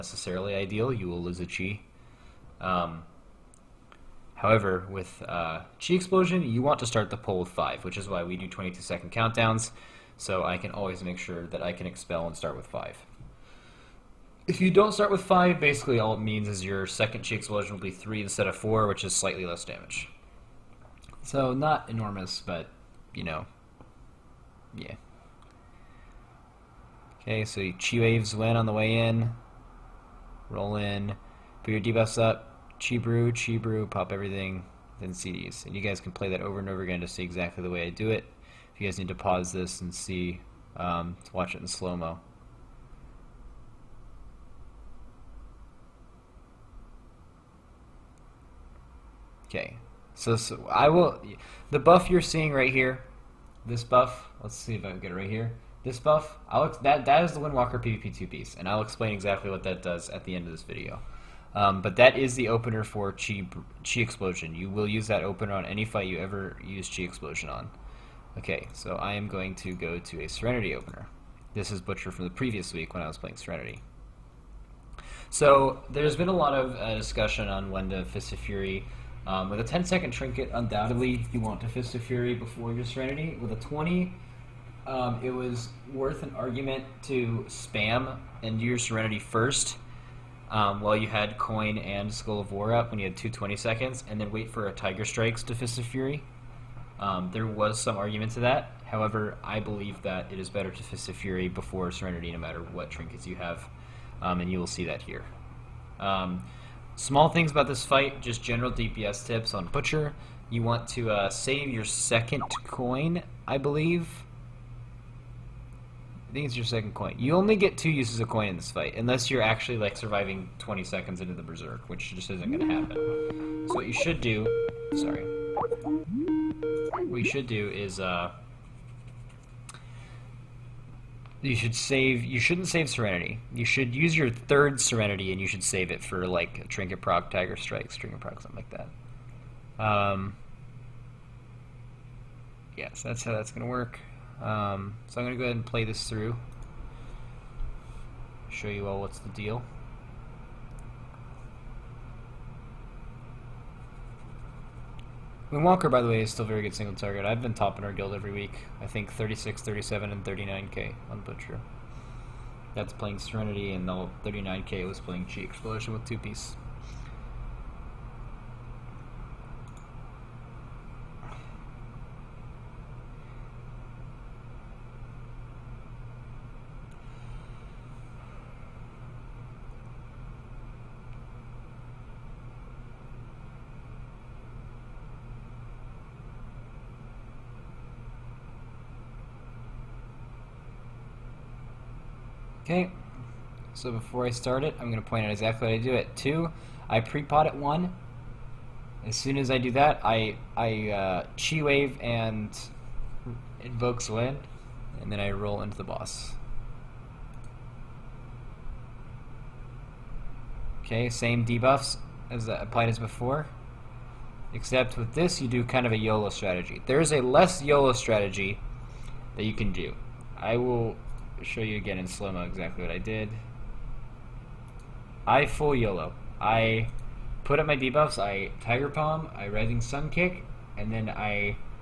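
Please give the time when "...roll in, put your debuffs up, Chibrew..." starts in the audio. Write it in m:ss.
0:30.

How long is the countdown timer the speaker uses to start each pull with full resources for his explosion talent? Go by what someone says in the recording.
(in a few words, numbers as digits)
22 seconds.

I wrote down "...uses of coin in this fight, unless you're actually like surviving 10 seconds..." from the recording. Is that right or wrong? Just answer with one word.
wrong.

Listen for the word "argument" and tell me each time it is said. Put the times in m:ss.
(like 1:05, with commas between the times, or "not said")
1:26, 1:37.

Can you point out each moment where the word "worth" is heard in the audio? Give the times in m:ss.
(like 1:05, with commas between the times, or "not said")
1:25.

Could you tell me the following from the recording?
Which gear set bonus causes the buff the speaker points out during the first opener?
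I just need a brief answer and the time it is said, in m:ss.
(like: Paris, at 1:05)
Windwalker PvP 2 piece, at 0:57.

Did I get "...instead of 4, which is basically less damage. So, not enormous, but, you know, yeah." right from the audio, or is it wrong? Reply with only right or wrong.
wrong.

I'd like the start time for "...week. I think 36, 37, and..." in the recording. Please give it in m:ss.
2:38.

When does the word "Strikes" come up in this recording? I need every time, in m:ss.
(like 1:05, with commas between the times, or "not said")
1:35, 2:17.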